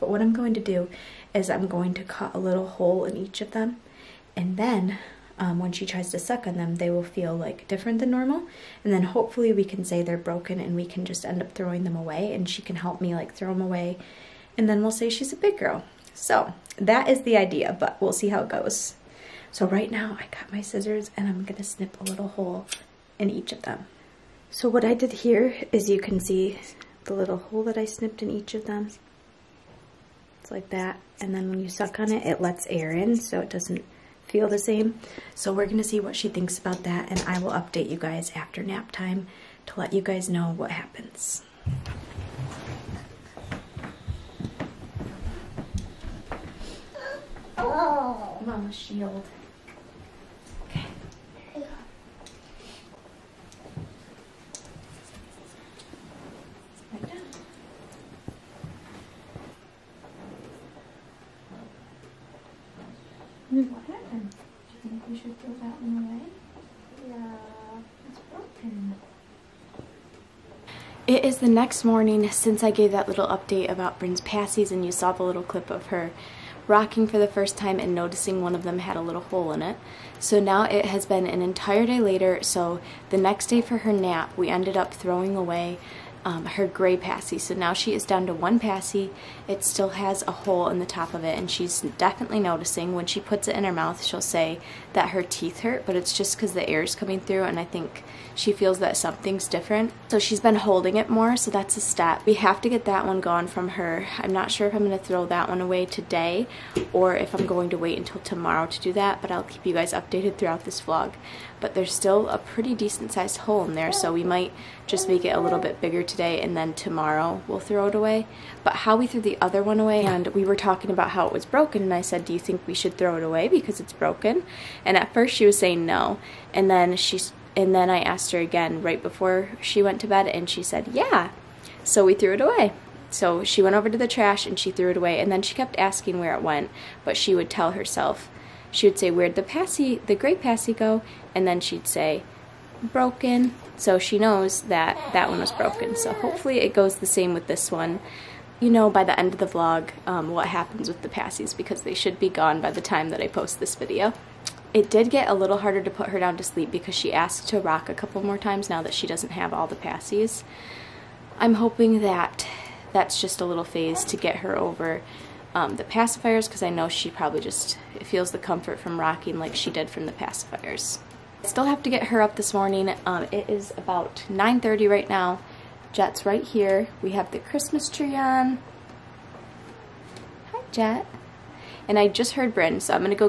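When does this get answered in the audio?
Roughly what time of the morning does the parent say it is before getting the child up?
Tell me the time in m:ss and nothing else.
2:54.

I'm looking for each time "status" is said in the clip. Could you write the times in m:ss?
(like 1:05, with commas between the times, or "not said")
not said.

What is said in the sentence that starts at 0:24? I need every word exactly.
So what I did here is you can see the little hole that I snipped in each of them.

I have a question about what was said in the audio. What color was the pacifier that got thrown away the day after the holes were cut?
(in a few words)
Gray.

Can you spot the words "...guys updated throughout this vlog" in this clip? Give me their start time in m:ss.
1:49.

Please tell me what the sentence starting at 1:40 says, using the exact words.
So she's been holding it more so that's a step.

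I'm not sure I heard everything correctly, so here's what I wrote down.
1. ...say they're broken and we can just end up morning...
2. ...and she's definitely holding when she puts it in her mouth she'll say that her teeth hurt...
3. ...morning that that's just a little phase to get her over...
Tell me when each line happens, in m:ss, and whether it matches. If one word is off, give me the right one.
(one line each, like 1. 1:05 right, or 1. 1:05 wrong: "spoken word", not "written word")
1. 0:09 wrong: "throwing", not "morning"
2. 1:31 wrong: "noticing", not "holding"
3. 2:41 wrong: "hoping", not "morning".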